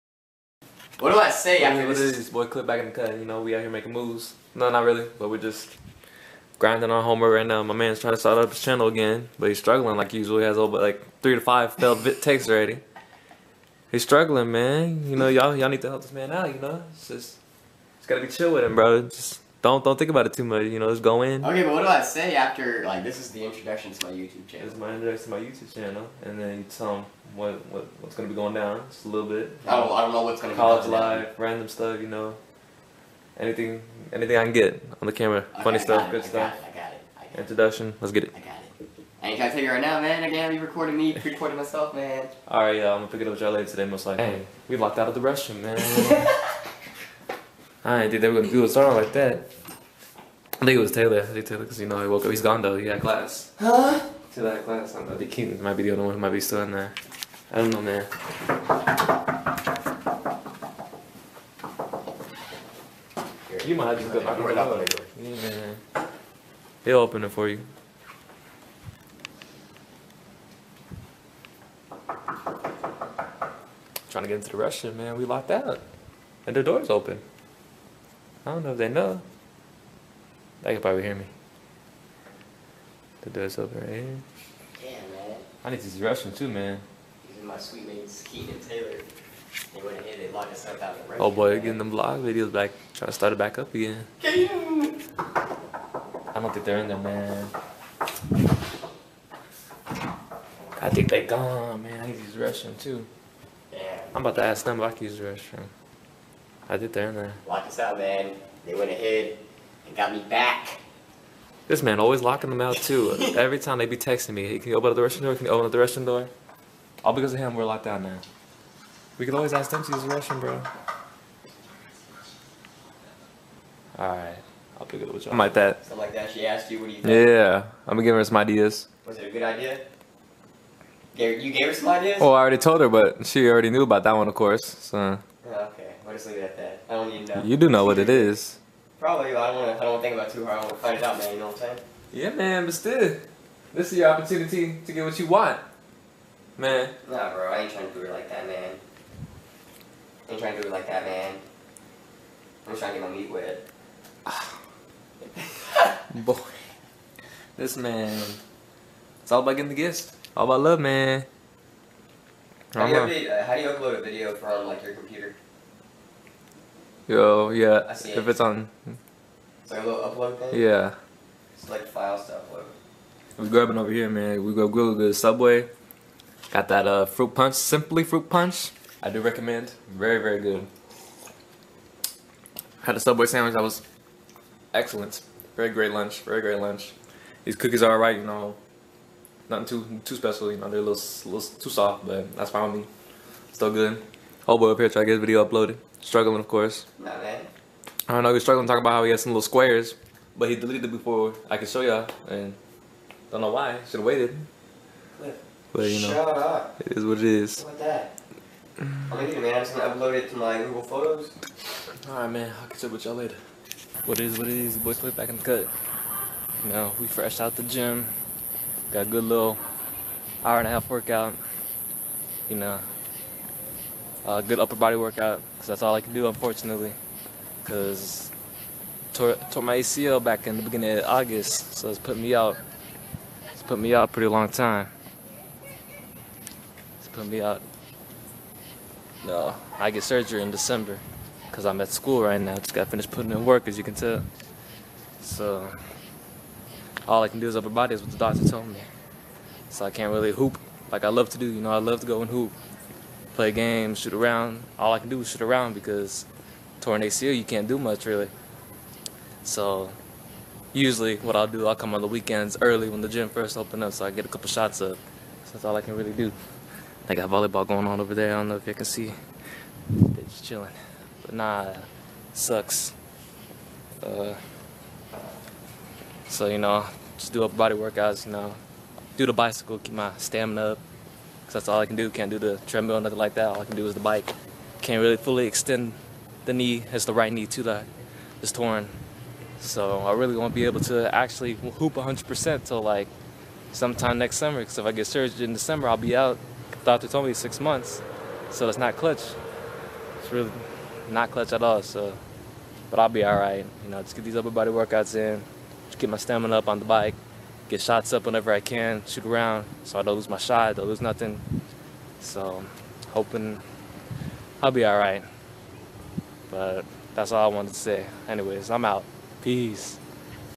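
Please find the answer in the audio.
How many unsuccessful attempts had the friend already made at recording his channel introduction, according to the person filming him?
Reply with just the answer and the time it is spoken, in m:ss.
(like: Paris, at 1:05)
3 to 5, at 0:11.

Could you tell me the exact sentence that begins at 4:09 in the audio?
So I can't really hoop like I love to do.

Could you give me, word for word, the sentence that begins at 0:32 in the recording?
You know, anything anything I can get on the camera, okay, funny stuff, it, good I stuff.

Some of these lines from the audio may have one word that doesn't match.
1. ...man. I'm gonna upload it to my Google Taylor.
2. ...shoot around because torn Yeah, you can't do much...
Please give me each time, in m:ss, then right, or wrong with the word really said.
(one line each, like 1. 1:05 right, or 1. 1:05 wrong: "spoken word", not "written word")
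1. 3:29 wrong: "Photos", not "Taylor"
2. 4:15 wrong: "ACL", not "Yeah".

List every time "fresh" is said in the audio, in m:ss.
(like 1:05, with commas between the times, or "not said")
3:37.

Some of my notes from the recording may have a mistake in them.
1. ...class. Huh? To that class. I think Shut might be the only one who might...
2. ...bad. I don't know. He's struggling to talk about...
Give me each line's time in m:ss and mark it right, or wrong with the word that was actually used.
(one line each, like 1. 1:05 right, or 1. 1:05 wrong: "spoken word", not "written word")
1. 0:53 wrong: "Keaton", not "Shut"
2. 3:17 right.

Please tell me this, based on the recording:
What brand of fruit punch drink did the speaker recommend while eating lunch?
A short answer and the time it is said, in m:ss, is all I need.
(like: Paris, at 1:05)
Simply, at 2:57.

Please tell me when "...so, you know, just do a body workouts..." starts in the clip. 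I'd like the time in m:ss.
4:36.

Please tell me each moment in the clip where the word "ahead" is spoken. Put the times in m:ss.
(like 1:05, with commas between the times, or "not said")
1:29, 1:48.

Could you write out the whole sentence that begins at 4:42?
Can't do the treadmill, nothing like that.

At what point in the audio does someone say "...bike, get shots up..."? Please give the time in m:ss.
5:06.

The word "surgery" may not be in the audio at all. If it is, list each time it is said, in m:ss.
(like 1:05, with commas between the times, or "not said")
4:00, 4:55.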